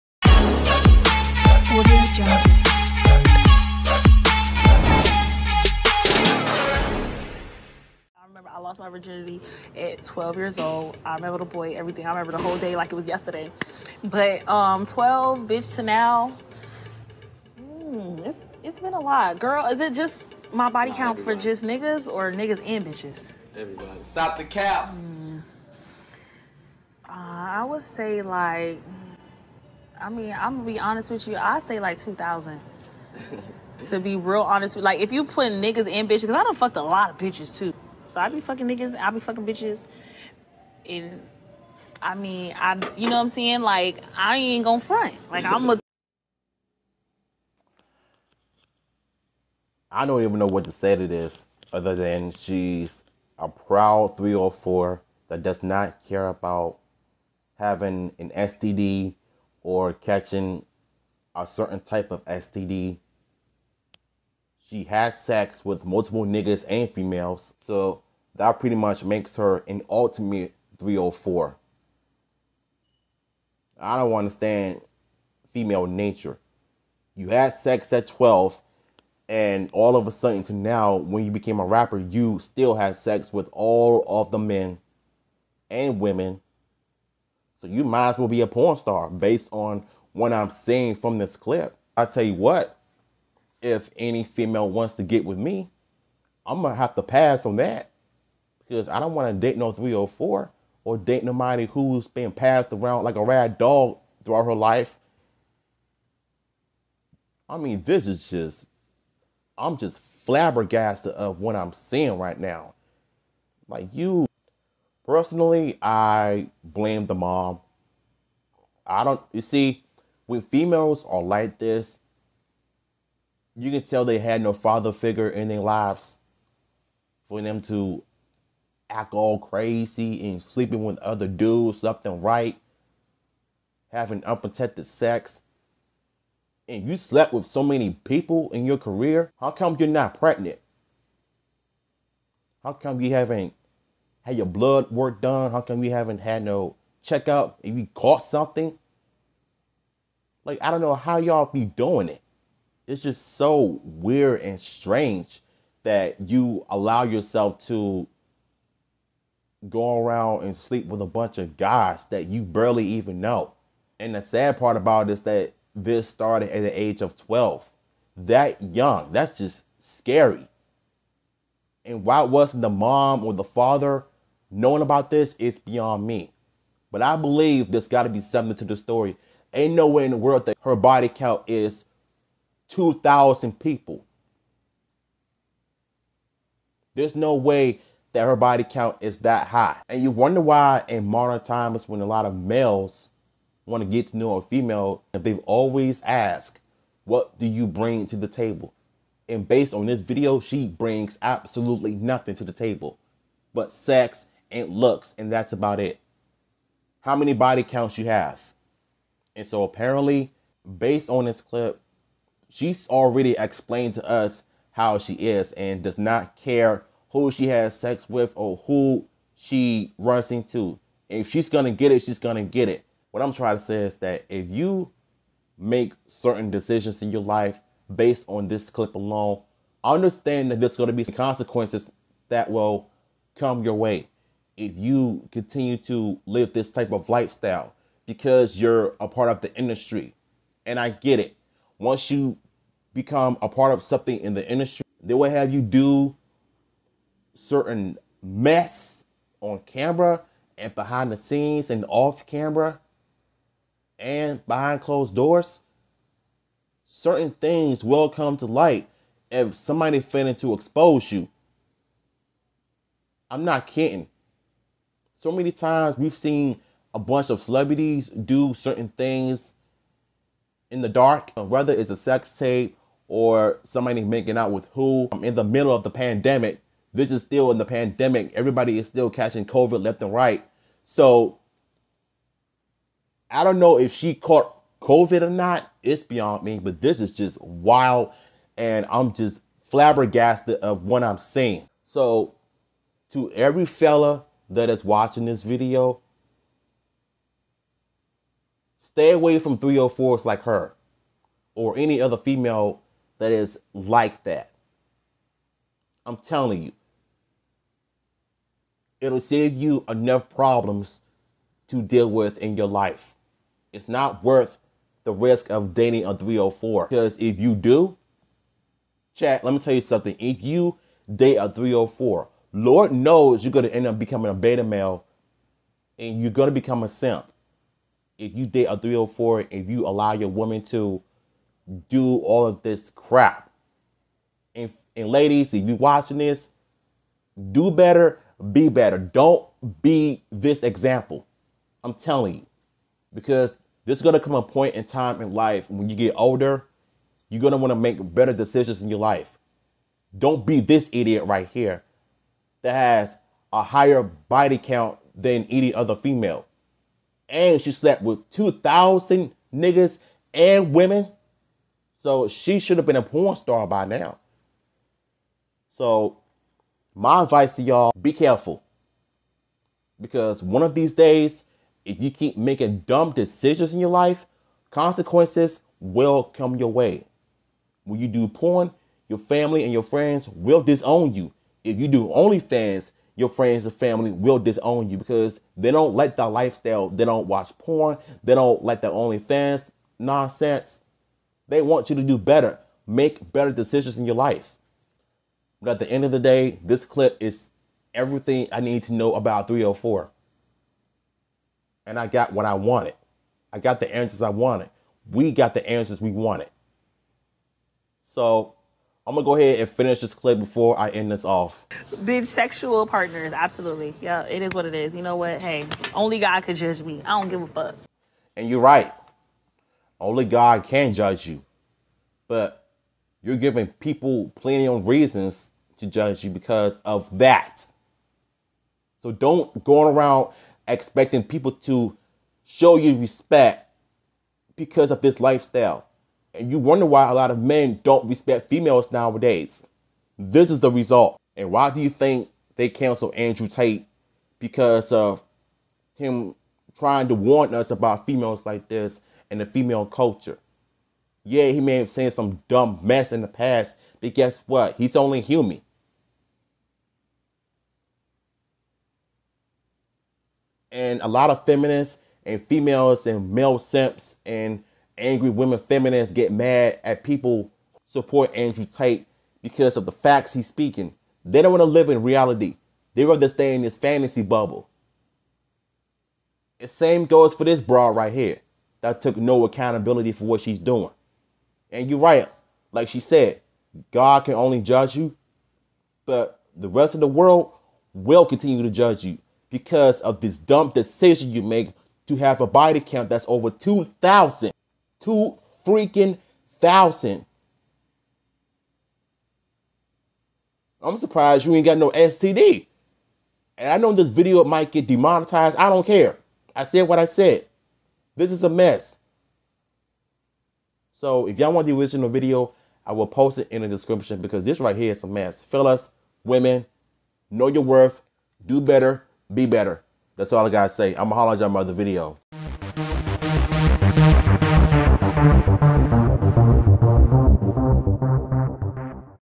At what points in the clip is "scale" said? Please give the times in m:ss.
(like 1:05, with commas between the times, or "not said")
not said.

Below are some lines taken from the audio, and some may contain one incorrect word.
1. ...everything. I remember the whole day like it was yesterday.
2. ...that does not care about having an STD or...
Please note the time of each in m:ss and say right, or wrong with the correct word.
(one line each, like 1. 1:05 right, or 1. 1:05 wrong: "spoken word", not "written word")
1. 0:11 right
2. 0:55 right.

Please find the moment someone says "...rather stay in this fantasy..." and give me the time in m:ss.
7:53.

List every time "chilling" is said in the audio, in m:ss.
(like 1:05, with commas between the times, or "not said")
not said.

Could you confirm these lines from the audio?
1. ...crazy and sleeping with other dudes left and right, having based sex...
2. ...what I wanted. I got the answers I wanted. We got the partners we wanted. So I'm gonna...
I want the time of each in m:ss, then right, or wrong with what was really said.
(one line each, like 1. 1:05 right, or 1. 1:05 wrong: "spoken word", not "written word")
1. 2:09 wrong: "unprotected", not "based"
2. 6:42 wrong: "answers", not "partners".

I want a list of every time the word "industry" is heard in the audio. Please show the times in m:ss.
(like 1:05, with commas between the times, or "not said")
3:59, 4:04.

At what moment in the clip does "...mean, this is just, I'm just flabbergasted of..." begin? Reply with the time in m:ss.
1:47.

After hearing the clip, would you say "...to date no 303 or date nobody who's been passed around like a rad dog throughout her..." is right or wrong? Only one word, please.
wrong.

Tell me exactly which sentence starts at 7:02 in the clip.
But you're giving people plenty of reasons to judge you because of that.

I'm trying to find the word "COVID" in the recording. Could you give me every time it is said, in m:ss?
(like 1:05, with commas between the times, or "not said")
4:39, 4:44.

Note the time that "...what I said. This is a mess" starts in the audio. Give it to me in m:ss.
8:26.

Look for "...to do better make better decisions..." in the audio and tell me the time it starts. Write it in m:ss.
6:31.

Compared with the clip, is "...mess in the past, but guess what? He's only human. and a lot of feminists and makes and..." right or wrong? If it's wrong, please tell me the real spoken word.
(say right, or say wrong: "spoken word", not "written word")
wrong: "females", not "makes".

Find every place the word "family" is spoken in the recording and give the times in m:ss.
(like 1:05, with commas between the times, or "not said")
6:19, 6:23.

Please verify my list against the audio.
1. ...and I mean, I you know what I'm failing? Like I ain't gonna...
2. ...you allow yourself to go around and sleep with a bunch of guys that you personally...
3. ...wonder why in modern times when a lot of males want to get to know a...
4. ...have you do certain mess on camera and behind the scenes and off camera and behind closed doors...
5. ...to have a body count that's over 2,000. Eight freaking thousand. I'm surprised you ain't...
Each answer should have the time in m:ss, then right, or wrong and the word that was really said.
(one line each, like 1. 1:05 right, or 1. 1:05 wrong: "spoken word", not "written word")
1. 0:40 wrong: "saying", not "failing"
2. 2:36 wrong: "barely", not "personally"
3. 3:10 right
4. 4:05 right
5. 8:12 wrong: "Two", not "Eight".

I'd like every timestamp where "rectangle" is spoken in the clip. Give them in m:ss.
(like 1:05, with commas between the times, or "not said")
not said.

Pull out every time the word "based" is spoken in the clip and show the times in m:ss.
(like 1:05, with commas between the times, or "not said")
1:29, 3:19, 3:30, 3:47.